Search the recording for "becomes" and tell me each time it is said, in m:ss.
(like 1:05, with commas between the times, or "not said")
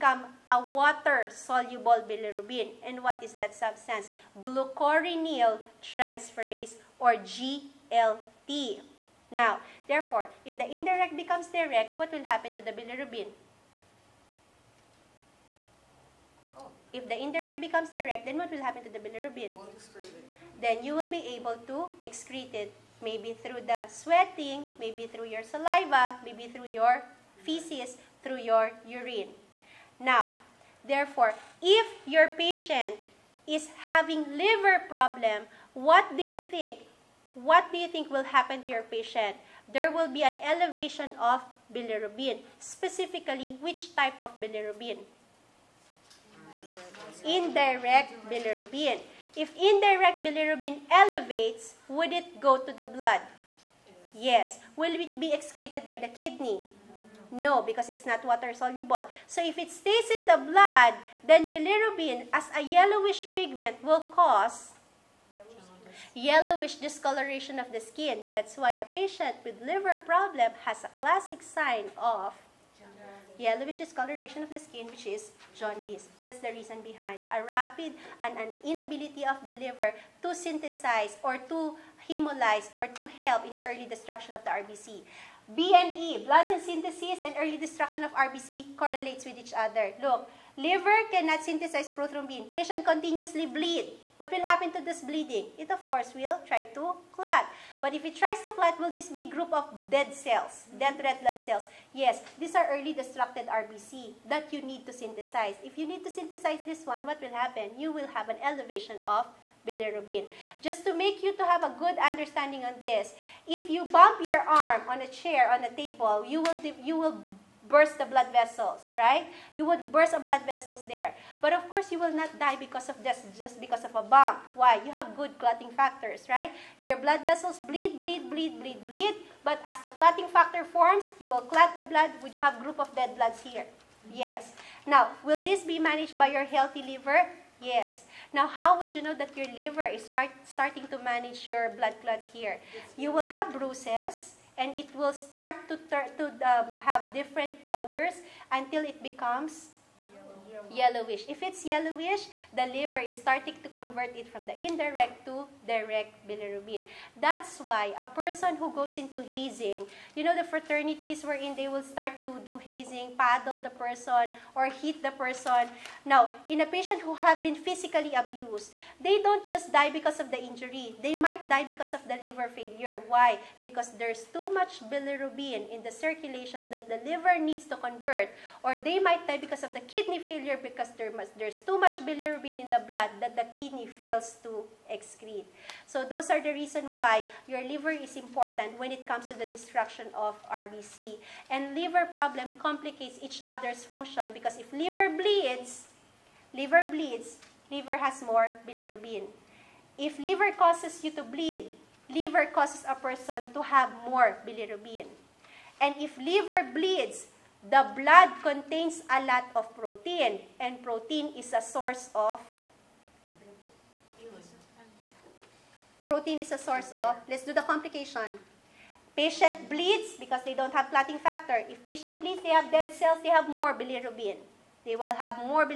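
0:11, 0:17, 2:29.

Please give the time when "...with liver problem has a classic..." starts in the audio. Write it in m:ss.
1:09.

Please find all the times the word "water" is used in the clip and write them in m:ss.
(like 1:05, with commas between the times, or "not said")
0:00, 0:58.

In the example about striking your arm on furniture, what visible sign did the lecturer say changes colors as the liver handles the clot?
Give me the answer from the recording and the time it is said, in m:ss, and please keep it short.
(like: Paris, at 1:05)
Bruises, at 2:23.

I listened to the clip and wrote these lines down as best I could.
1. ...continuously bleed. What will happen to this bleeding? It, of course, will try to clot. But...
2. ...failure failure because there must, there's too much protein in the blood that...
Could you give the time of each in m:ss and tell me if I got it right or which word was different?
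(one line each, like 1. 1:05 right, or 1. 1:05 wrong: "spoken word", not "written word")
1. 1:32 right
2. 3:00 wrong: "bilirubin", not "protein".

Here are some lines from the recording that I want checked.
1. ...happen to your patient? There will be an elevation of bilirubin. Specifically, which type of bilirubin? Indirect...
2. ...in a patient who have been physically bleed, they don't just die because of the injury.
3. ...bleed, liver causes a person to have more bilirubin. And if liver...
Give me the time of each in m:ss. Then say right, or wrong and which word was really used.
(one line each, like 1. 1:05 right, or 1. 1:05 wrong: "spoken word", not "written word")
1. 0:38 right
2. 2:46 wrong: "abused", not "bleed"
3. 3:21 right.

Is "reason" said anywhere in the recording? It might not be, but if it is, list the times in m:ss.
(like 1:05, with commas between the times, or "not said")
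1:16, 3:06.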